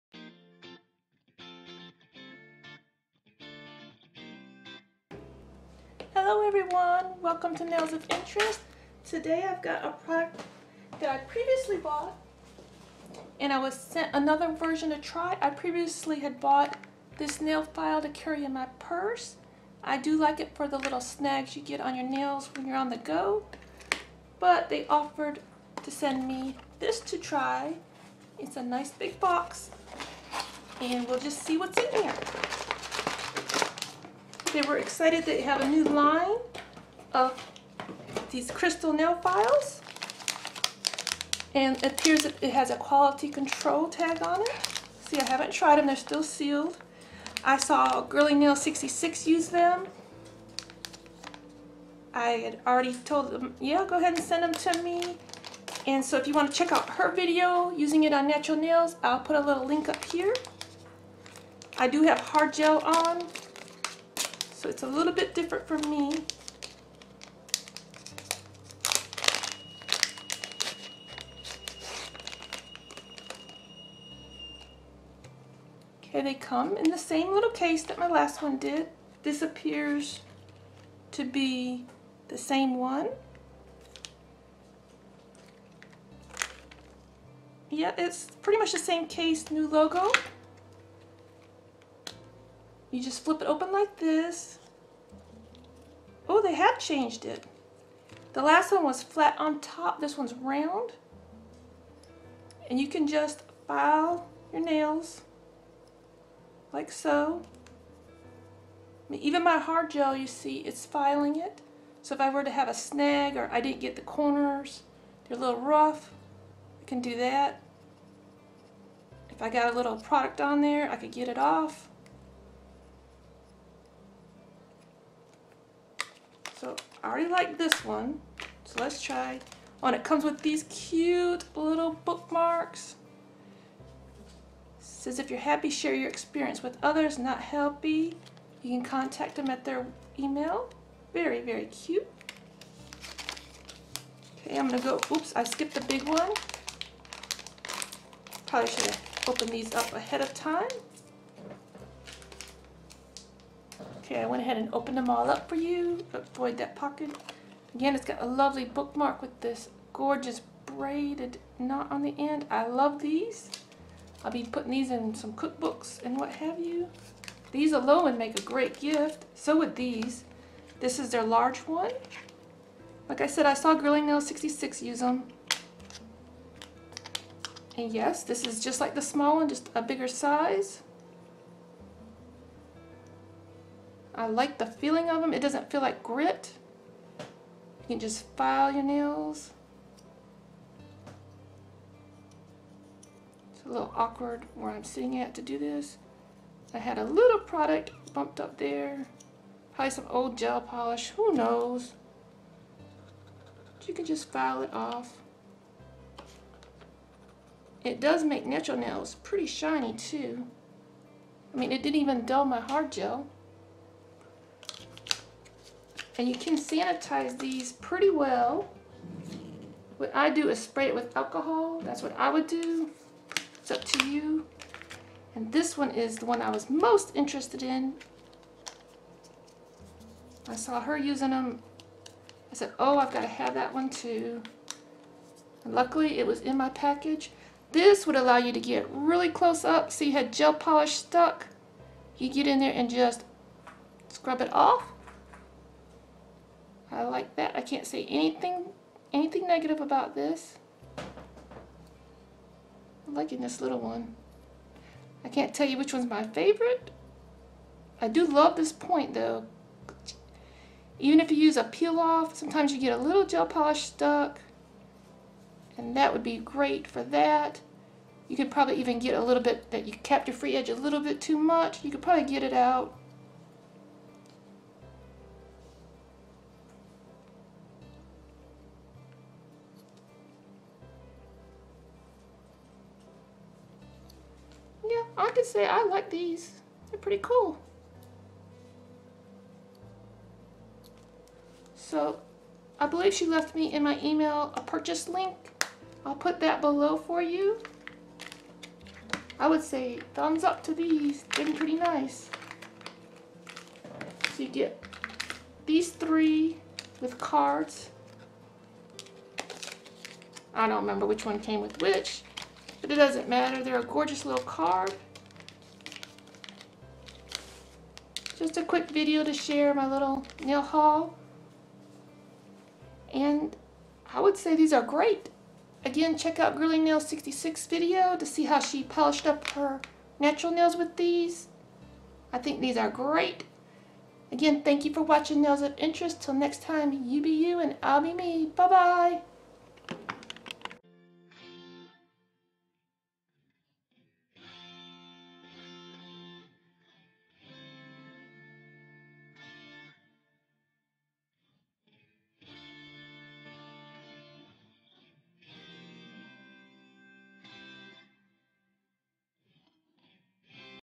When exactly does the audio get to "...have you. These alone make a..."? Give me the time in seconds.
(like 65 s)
166 s.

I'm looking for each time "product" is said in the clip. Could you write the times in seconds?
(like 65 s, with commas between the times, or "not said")
10 s, 119 s, 197 s.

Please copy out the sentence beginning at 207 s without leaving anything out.
It does make natural nails pretty shiny too.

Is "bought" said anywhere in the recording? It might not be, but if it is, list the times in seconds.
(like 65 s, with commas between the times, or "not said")
11 s, 16 s.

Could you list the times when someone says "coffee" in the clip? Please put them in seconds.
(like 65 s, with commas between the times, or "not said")
not said.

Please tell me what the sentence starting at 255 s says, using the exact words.
I can't tell you which one's my favorite.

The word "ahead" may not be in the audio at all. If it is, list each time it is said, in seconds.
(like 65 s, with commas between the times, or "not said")
53 s, 149 s, 154 s.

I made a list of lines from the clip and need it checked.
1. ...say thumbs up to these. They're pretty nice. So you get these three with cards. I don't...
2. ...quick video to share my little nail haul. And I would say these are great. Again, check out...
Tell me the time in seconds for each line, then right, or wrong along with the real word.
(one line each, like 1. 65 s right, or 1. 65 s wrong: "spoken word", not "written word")
1. 299 s right
2. 318 s right.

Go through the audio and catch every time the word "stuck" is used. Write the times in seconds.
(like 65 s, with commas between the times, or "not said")
240 s, 263 s.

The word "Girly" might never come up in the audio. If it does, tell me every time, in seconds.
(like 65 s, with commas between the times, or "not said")
48 s, 173 s, 326 s.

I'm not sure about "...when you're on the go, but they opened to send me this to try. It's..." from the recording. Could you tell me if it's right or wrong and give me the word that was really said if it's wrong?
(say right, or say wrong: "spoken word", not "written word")
wrong: "offered", not "opened".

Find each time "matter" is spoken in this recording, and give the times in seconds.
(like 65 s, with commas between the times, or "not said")
313 s.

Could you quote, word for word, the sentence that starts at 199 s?
Probably some old gel polish, who knows.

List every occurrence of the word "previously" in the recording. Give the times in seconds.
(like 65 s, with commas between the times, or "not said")
11 s, 15 s.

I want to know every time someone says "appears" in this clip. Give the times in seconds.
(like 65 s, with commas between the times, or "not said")
41 s, 79 s.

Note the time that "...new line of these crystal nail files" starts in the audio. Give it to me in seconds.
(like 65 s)
35 s.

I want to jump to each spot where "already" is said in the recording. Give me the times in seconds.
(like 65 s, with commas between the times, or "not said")
52 s, 127 s.